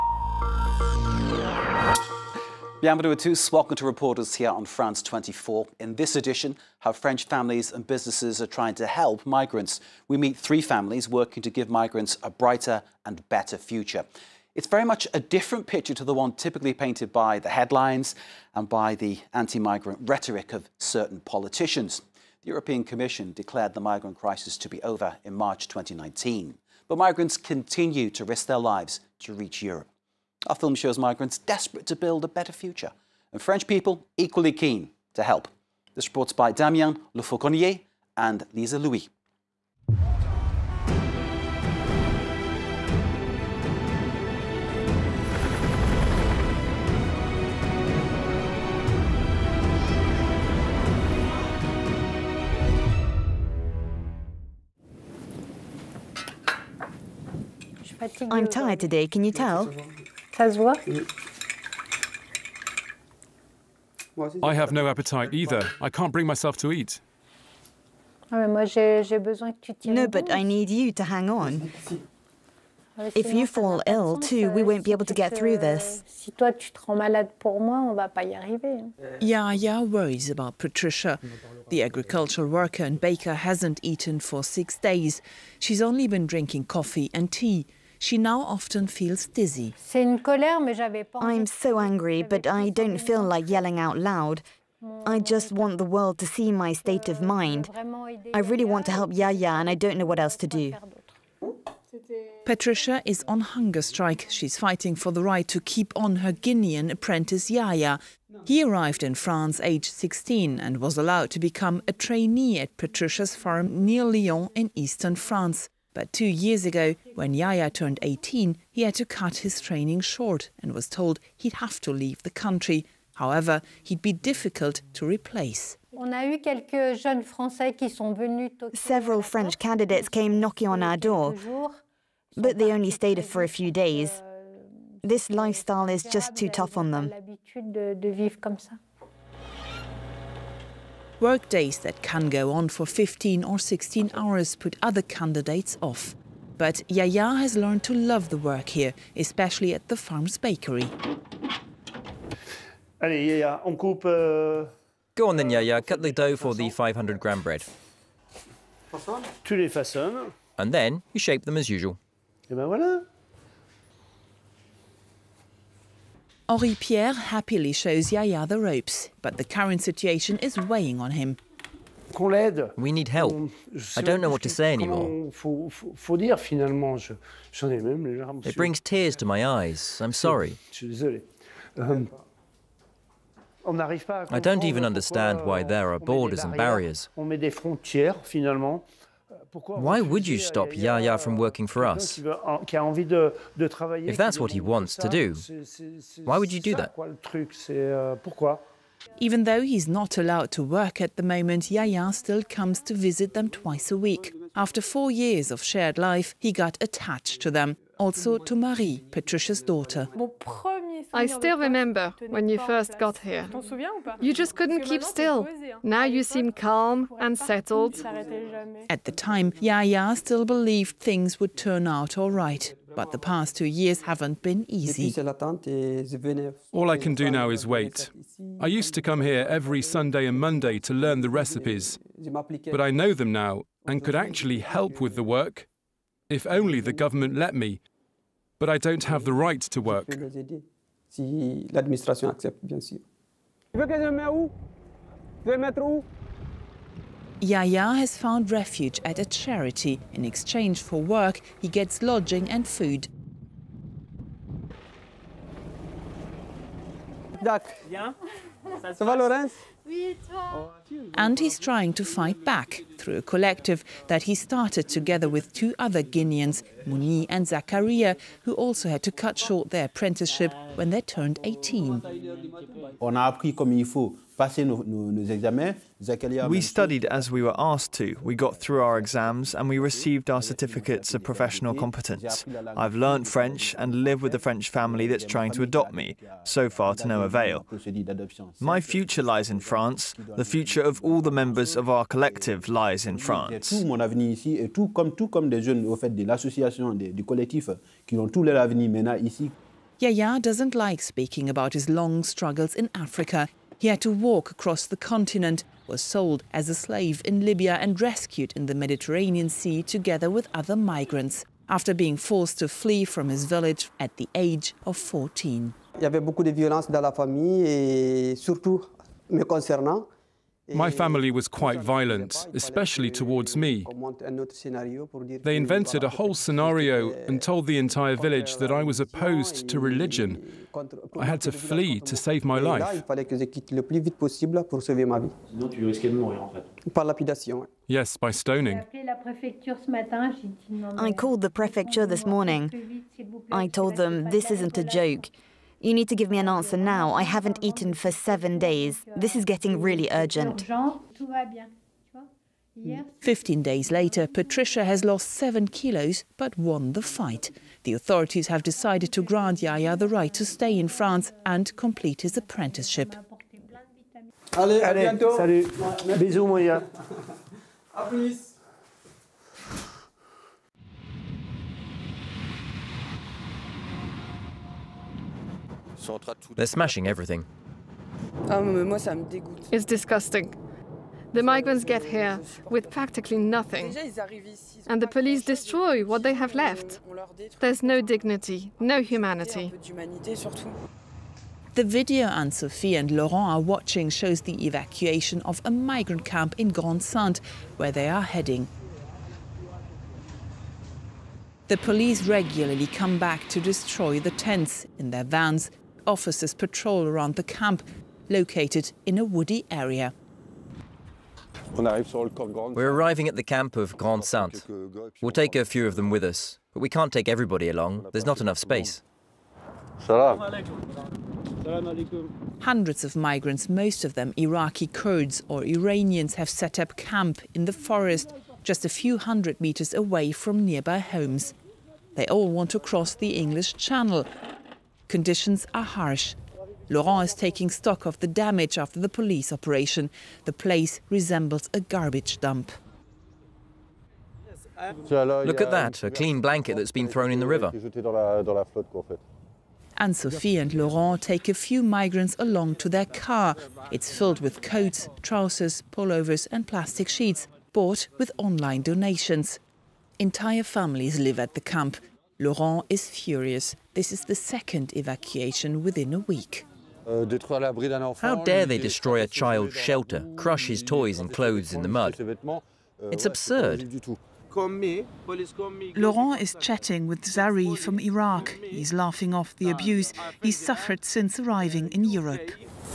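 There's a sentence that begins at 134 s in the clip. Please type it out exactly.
Euh, this lifestyle is just too tough on them.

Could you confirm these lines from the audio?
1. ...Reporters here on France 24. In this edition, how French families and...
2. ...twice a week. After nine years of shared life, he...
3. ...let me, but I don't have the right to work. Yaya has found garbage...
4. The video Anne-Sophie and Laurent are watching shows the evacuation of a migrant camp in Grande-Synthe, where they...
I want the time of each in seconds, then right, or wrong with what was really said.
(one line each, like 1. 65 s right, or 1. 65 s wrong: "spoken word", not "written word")
1. 3 s right
2. 203 s wrong: "four", not "nine"
3. 237 s wrong: "refuge", not "garbage"
4. 391 s right.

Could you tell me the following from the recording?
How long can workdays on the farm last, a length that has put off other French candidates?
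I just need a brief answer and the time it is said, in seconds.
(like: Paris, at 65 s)
15 or 16 hours, at 142 s.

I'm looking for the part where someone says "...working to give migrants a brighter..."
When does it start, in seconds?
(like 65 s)
11 s.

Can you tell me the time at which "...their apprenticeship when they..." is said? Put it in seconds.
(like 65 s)
269 s.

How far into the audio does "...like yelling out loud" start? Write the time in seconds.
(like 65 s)
93 s.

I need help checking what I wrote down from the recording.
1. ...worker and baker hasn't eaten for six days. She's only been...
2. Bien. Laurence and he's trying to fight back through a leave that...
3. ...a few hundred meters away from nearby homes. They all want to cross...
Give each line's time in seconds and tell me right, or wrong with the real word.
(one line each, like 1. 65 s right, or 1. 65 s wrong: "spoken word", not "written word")
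1. 82 s right
2. 257 s wrong: "collective", not "leave"
3. 428 s right.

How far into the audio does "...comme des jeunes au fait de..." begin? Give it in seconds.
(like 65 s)
295 s.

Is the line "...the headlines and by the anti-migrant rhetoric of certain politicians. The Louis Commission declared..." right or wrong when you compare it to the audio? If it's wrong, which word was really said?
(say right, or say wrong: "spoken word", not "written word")
wrong: "European", not "Louis".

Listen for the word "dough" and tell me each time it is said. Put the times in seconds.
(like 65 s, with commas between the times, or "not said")
156 s.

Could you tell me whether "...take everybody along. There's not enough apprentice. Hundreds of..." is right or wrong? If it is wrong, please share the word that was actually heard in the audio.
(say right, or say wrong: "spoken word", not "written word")
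wrong: "space", not "apprentice".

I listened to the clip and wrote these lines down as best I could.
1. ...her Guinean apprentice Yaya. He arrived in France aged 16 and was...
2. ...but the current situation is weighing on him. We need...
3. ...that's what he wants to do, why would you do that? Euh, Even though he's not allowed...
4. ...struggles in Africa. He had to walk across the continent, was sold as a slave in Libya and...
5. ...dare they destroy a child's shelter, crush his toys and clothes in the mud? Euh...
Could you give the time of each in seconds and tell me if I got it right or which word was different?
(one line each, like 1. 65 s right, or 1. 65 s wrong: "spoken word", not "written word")
1. 106 s right
2. 169 s right
3. 194 s right
4. 302 s right
5. 468 s right.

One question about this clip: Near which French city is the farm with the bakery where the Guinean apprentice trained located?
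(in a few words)
Lyon.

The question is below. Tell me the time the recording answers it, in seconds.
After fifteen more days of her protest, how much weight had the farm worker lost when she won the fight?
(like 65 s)
355 s.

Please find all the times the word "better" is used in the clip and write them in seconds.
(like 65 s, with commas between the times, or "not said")
13 s, 32 s.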